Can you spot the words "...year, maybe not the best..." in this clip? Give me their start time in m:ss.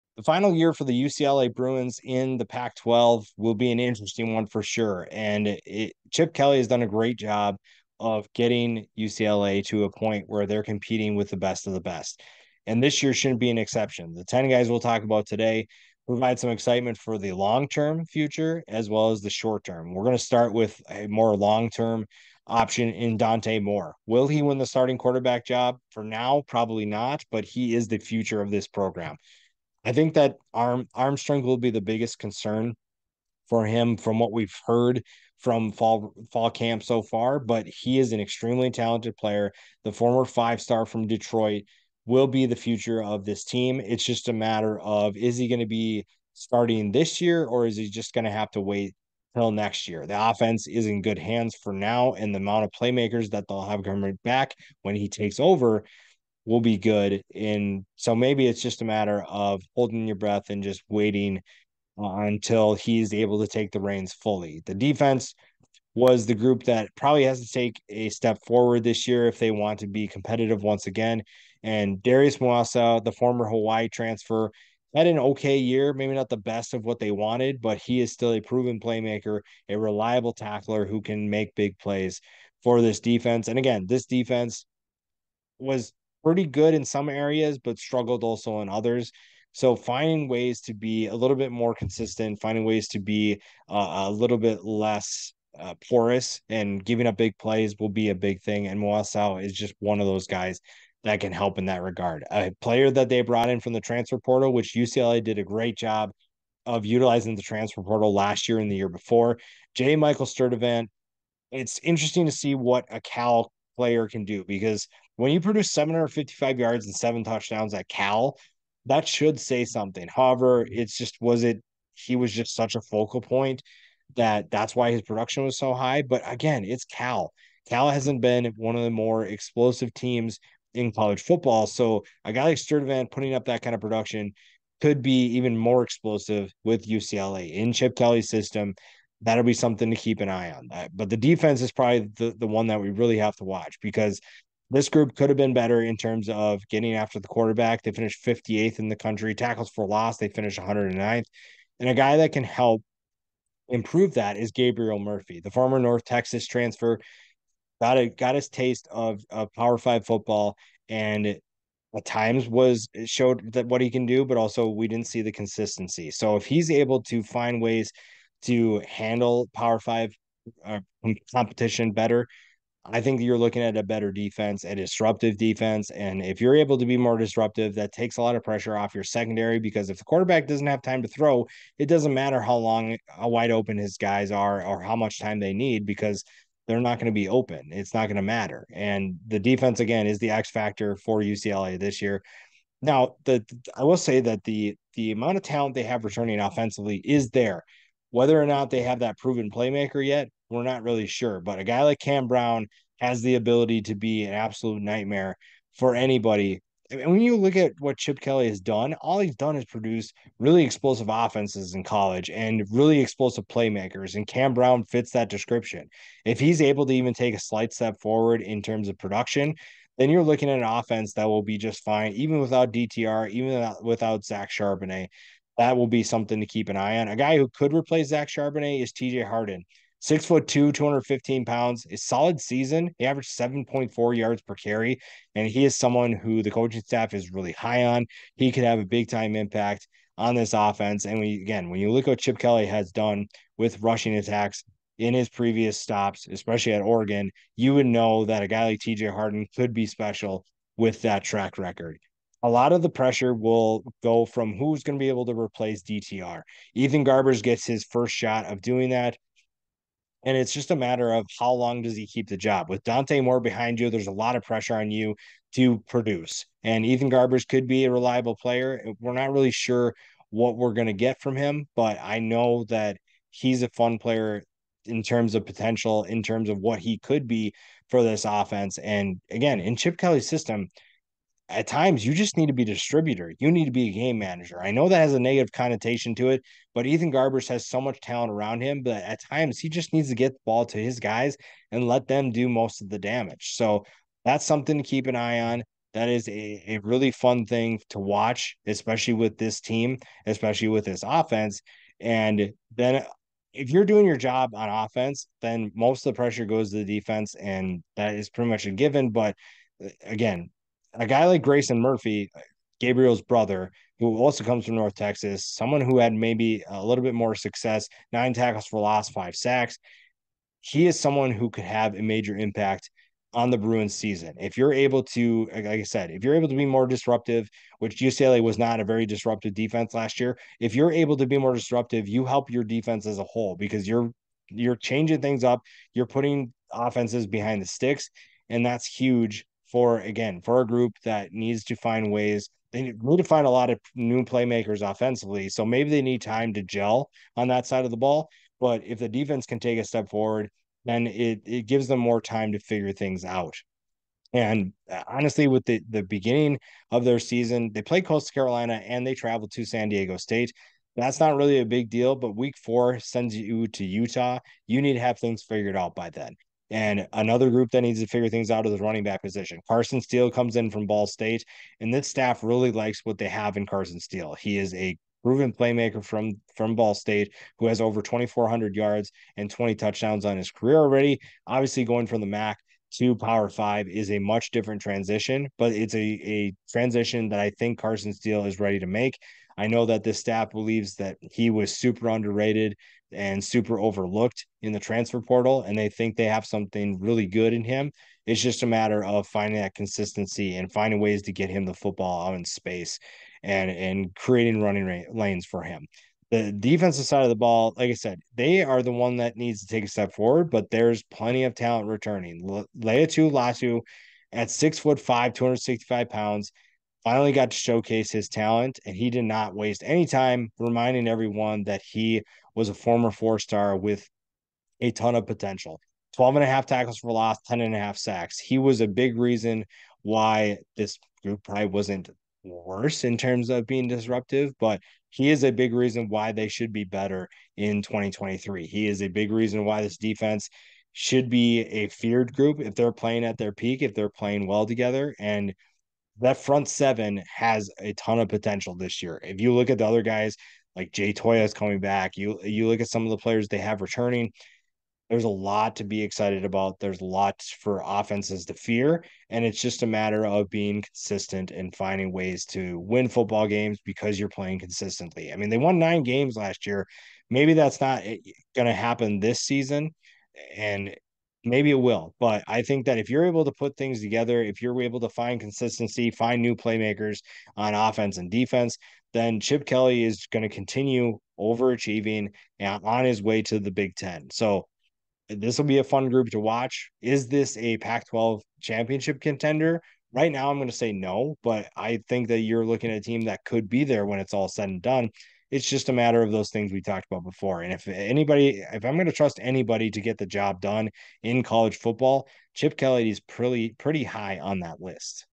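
1:15.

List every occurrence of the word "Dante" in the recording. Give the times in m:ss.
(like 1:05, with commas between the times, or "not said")
0:23, 4:22.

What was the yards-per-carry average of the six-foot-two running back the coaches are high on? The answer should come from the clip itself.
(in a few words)
7.4.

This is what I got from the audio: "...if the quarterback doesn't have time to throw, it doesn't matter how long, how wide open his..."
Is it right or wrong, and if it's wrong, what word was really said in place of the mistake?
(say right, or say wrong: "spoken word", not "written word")
right.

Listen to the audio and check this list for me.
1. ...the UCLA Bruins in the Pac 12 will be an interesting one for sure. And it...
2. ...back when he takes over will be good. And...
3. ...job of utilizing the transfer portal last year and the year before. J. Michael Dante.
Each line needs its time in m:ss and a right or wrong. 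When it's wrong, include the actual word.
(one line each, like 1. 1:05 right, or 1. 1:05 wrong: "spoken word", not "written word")
1. 0:00 right
2. 0:54 right
3. 1:45 wrong: "Sturdivant", not "Dante".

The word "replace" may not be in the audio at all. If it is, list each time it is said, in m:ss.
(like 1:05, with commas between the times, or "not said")
3:47, 4:15.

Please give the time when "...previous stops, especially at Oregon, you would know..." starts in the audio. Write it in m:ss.
4:05.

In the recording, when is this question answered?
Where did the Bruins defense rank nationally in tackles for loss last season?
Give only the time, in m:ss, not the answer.
2:30.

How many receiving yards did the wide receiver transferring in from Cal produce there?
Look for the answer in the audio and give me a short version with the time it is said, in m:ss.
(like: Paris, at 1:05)
755, at 1:55.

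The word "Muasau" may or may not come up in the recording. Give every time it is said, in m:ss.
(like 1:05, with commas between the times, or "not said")
1:12, 1:38.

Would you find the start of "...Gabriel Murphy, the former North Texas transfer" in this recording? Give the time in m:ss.
2:34.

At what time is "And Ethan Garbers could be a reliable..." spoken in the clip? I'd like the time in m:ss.
4:26.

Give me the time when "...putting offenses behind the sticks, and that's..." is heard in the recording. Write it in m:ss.
5:36.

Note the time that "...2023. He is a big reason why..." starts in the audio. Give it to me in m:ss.
7:17.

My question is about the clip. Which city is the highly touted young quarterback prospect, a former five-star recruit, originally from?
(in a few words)
Detroit.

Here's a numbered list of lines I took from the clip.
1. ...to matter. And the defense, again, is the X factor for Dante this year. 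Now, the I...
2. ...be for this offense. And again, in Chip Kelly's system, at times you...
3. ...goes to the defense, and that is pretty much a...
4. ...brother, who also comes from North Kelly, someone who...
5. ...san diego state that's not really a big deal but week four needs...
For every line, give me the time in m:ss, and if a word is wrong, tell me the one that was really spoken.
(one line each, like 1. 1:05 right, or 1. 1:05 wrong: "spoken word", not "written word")
1. 3:08 wrong: "UCLA", not "Dante"
2. 4:37 right
3. 5:06 right
4. 5:13 wrong: "Texas", not "Kelly"
5. 5:59 wrong: "sends", not "needs".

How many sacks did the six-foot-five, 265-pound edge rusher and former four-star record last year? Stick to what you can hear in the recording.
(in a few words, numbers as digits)
10.5.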